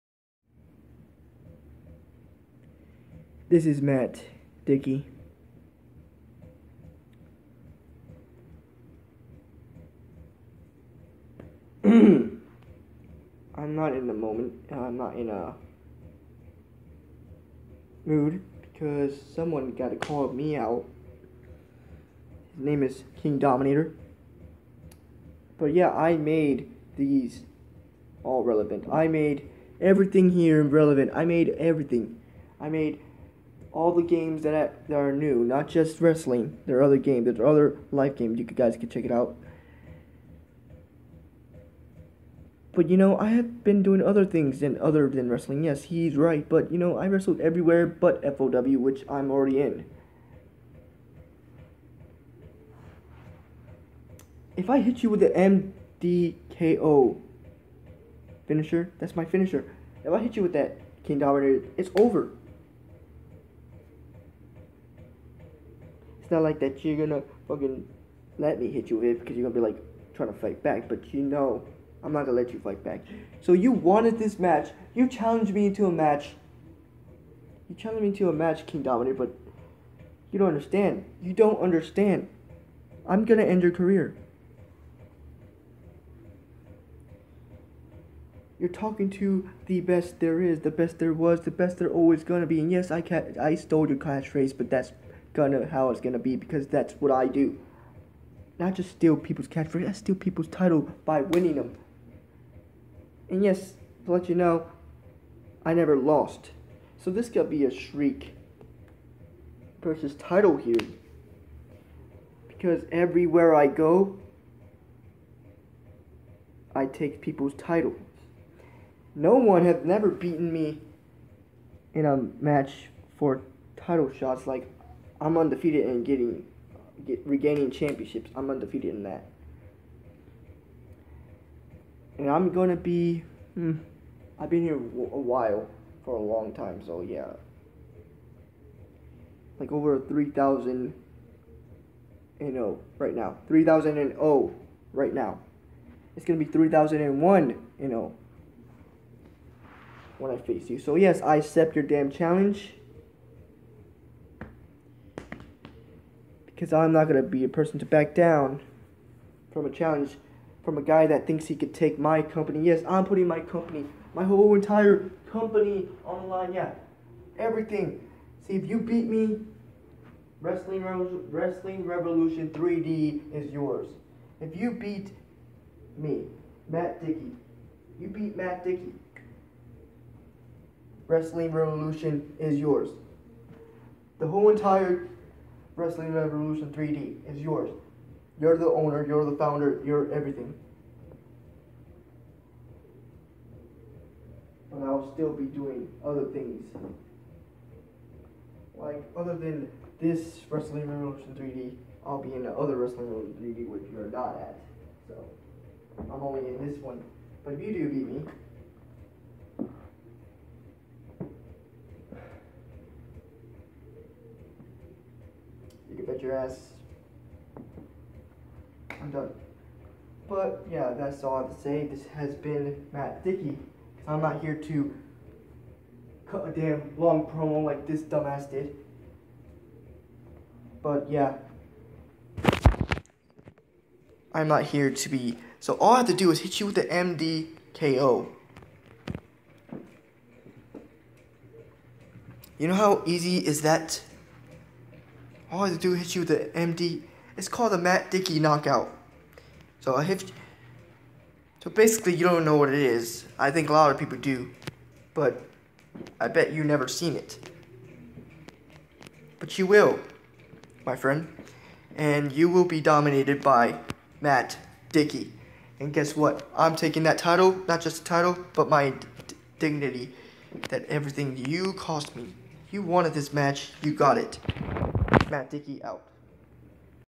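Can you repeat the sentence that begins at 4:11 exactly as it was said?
So basically, you don't know what it is.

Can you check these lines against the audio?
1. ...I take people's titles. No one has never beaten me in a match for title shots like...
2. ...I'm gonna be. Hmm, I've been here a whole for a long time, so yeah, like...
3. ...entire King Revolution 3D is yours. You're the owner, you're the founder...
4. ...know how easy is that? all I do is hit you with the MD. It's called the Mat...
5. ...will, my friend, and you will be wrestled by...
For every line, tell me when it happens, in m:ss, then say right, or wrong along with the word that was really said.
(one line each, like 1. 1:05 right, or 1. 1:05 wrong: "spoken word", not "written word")
1. 1:56 right
2. 2:12 wrong: "while", not "whole"
3. 3:04 wrong: "Wrestling", not "King"
4. 4:02 right
5. 4:19 wrong: "dominated", not "wrestled".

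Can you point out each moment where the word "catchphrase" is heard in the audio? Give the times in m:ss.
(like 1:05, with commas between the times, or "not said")
1:33, 1:39.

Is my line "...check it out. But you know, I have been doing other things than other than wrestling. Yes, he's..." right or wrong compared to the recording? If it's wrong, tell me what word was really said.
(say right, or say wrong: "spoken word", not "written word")
right.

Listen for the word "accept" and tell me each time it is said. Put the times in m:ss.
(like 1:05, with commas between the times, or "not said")
2:31.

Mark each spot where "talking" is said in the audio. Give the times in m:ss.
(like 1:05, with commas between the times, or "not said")
1:28.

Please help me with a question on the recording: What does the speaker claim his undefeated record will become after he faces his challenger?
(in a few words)
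3001-0.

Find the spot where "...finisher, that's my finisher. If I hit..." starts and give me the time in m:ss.
0:58.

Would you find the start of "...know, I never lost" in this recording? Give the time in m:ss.
1:44.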